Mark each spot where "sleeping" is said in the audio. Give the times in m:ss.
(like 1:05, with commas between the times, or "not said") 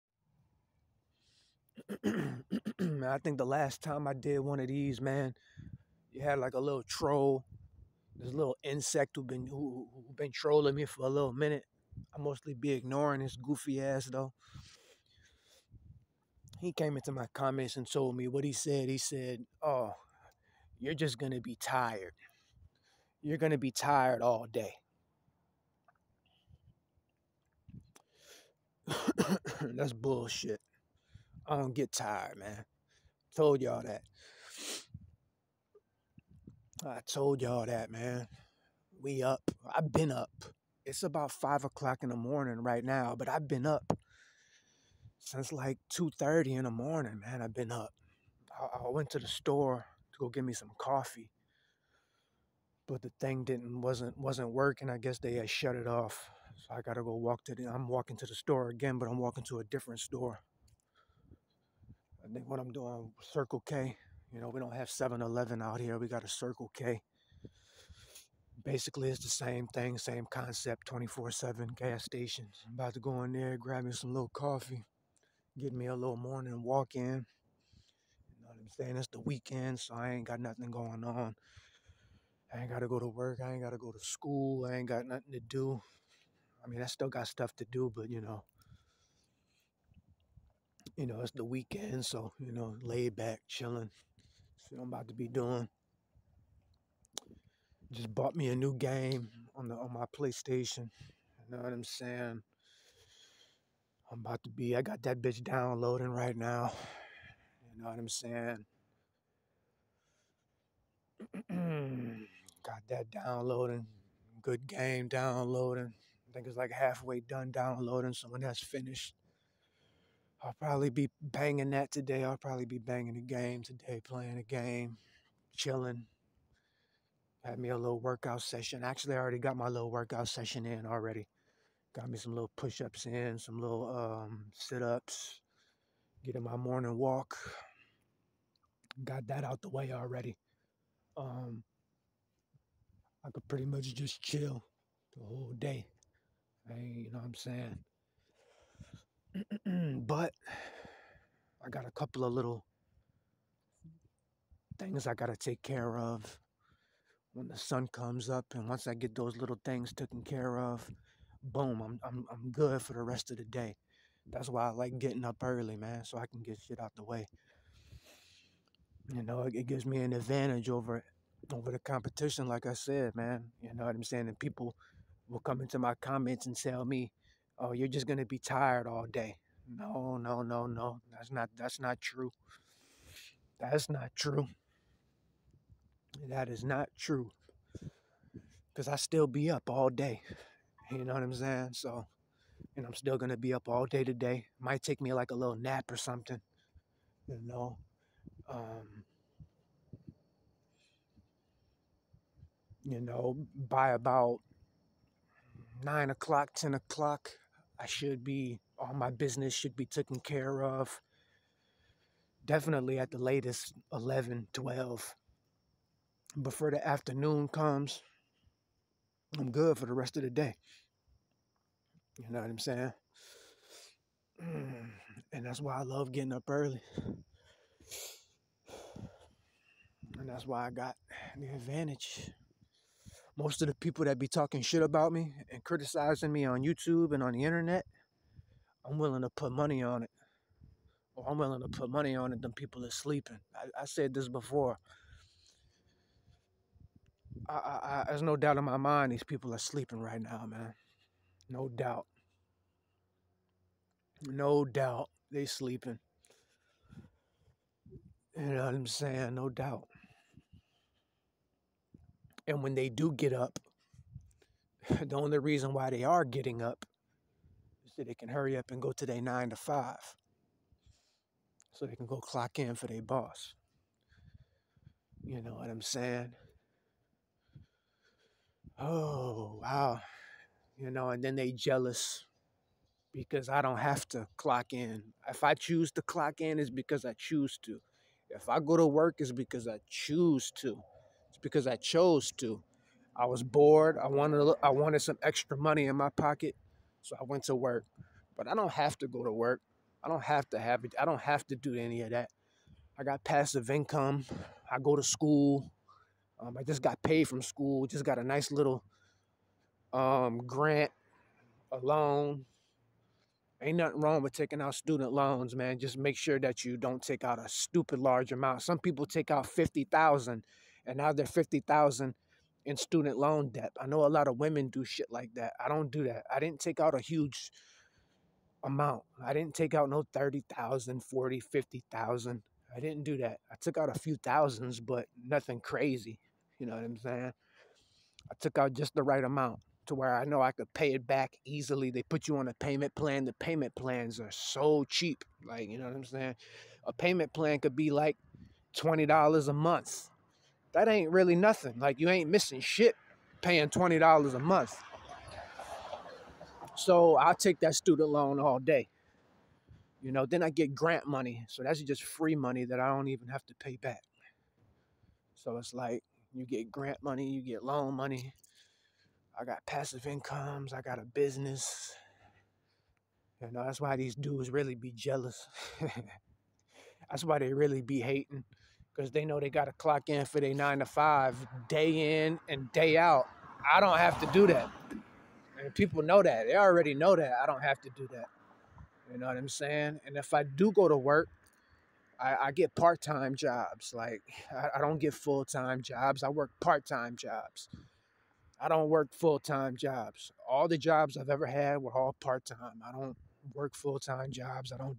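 4:02, 4:09, 4:15.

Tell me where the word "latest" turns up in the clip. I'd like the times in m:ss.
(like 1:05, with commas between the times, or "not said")
3:33.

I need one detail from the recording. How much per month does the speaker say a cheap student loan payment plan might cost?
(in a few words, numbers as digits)
$20.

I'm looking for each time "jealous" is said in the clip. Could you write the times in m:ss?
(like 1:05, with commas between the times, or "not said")
4:41, 6:14.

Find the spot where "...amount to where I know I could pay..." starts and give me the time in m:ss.
5:39.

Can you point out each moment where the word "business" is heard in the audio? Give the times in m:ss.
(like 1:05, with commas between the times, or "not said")
3:29, 6:11.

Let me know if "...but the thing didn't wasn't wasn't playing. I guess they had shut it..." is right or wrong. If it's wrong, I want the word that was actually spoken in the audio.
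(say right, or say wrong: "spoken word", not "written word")
wrong: "working", not "playing".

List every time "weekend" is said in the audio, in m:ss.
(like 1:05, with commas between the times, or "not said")
1:19, 1:31.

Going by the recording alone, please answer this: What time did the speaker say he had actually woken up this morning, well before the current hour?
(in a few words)
2:30.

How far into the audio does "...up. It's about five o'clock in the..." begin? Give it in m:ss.
0:40.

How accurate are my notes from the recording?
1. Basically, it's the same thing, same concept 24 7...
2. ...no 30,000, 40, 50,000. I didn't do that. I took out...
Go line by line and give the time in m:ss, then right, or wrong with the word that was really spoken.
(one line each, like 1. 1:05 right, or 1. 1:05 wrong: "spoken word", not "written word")
1. 1:08 right
2. 5:29 right.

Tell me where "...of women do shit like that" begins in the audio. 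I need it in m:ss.
5:24.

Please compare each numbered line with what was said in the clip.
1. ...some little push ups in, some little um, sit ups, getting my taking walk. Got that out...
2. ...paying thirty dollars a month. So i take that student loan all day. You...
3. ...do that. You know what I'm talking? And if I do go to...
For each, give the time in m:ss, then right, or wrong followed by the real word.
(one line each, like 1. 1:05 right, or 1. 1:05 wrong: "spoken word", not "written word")
1. 2:12 wrong: "morning", not "taking"
2. 5:53 wrong: "twenty", not "thirty"
3. 6:27 wrong: "saying", not "talking".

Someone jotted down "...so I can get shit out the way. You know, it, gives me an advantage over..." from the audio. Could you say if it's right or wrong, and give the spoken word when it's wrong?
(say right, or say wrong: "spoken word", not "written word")
right.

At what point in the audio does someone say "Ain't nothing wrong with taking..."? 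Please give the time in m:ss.
5:13.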